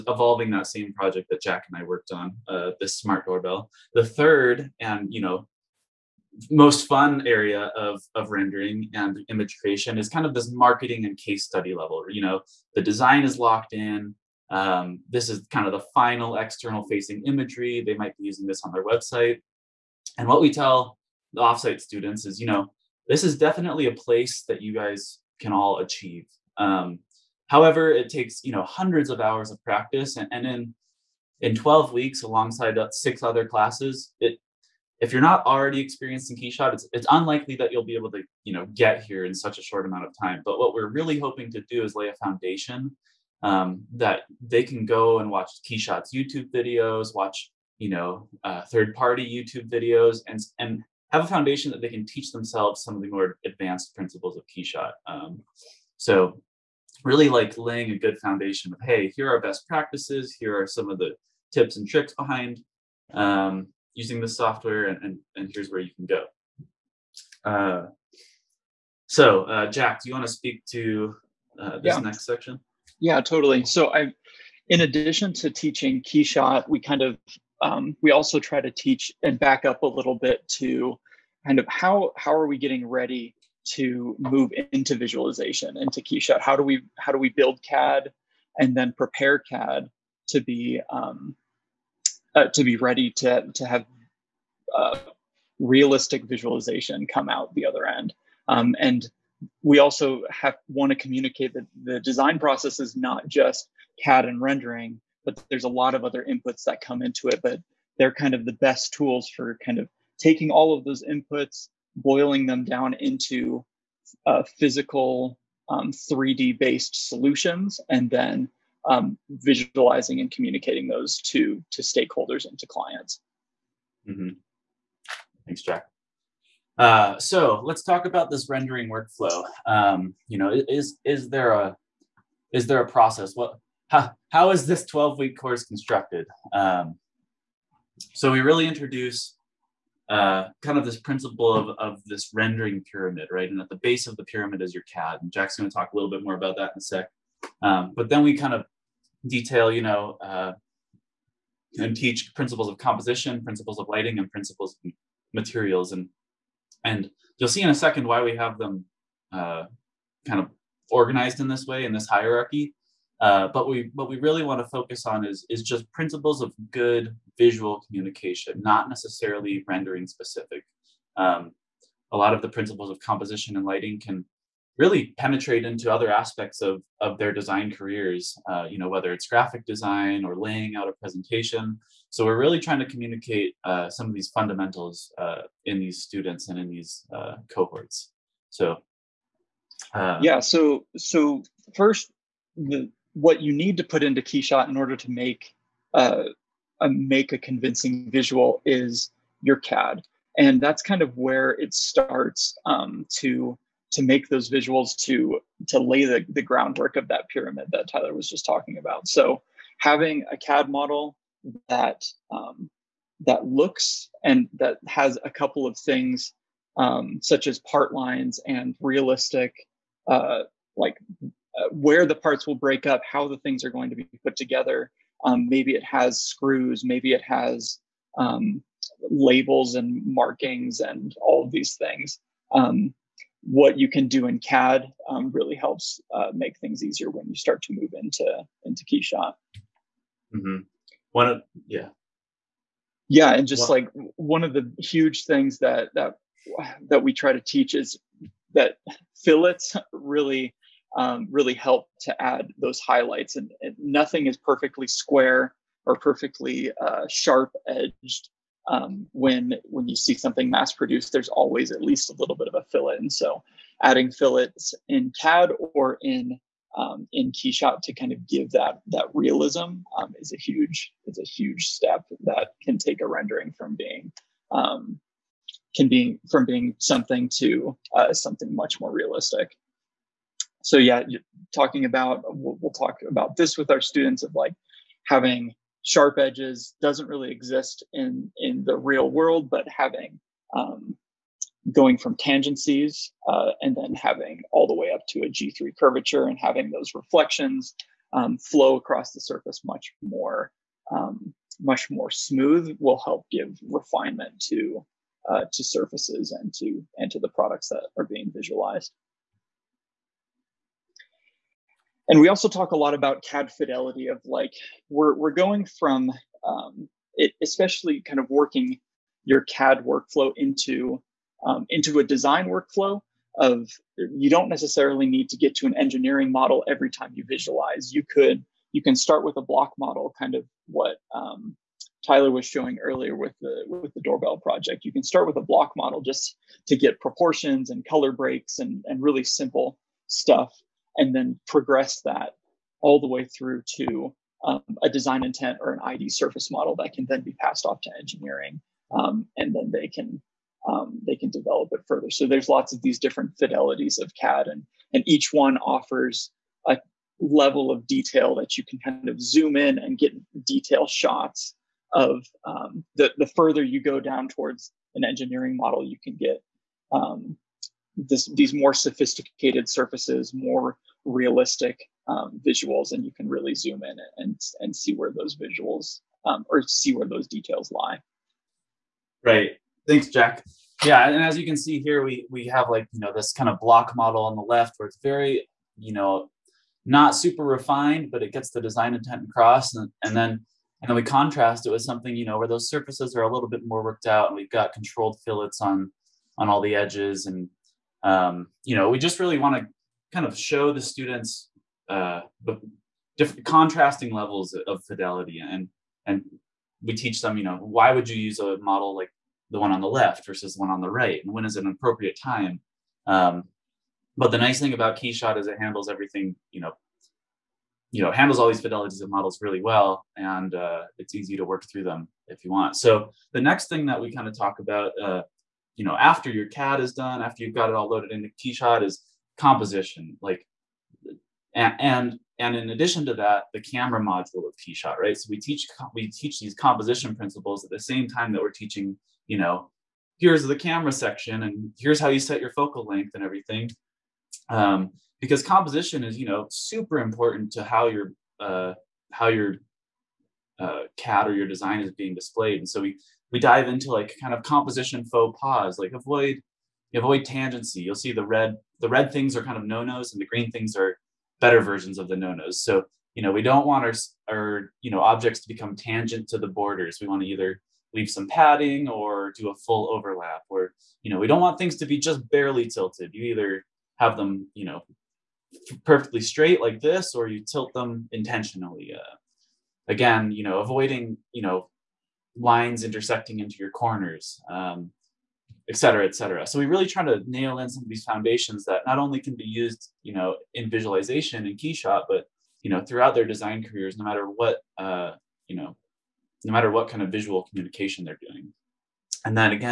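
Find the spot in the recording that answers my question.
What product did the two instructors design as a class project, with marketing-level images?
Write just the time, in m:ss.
0:02.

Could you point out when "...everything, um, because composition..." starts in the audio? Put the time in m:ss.
7:23.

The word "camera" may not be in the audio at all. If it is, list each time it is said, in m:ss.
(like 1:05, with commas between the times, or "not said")
7:13, 7:20.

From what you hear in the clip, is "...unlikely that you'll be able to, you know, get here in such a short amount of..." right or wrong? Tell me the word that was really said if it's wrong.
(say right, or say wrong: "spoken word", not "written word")
right.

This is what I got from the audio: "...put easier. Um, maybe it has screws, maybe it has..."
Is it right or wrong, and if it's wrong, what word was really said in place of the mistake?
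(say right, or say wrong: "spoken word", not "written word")
wrong: "together", not "easier".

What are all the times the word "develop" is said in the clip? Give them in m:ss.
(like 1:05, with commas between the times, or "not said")
5:51.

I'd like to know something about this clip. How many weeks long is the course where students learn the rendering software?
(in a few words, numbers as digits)
12.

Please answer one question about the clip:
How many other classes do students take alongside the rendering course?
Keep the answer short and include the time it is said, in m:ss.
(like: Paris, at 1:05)
6, at 0:32.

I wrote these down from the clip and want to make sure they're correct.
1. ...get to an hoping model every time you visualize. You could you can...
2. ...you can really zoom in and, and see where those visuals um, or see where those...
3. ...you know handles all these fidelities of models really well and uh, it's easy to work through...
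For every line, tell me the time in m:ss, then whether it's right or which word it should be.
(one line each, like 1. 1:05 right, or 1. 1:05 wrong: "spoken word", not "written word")
1. 5:25 wrong: "engineering", not "hoping"
2. 6:13 right
3. 6:57 right.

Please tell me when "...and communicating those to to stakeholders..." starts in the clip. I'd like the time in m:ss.
2:00.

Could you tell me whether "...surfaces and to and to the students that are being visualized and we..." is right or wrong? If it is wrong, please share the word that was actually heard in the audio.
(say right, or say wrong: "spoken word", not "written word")
wrong: "products", not "students".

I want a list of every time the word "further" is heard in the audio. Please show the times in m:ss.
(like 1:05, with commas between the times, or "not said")
5:51, 6:03.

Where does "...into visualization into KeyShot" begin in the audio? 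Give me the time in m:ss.
1:24.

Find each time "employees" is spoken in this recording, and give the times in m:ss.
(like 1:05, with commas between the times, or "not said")
not said.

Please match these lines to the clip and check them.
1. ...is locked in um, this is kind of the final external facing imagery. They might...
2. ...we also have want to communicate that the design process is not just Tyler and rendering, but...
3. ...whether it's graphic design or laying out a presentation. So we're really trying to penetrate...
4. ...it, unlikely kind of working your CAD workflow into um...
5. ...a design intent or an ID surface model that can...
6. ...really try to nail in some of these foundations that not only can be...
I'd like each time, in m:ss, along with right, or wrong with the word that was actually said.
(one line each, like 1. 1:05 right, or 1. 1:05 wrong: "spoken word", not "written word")
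1. 0:13 right
2. 1:39 wrong: "CAD", not "Tyler"
3. 2:58 wrong: "communicate", not "penetrate"
4. 5:17 wrong: "especially", not "unlikely"
5. 5:44 right
6. 8:06 right.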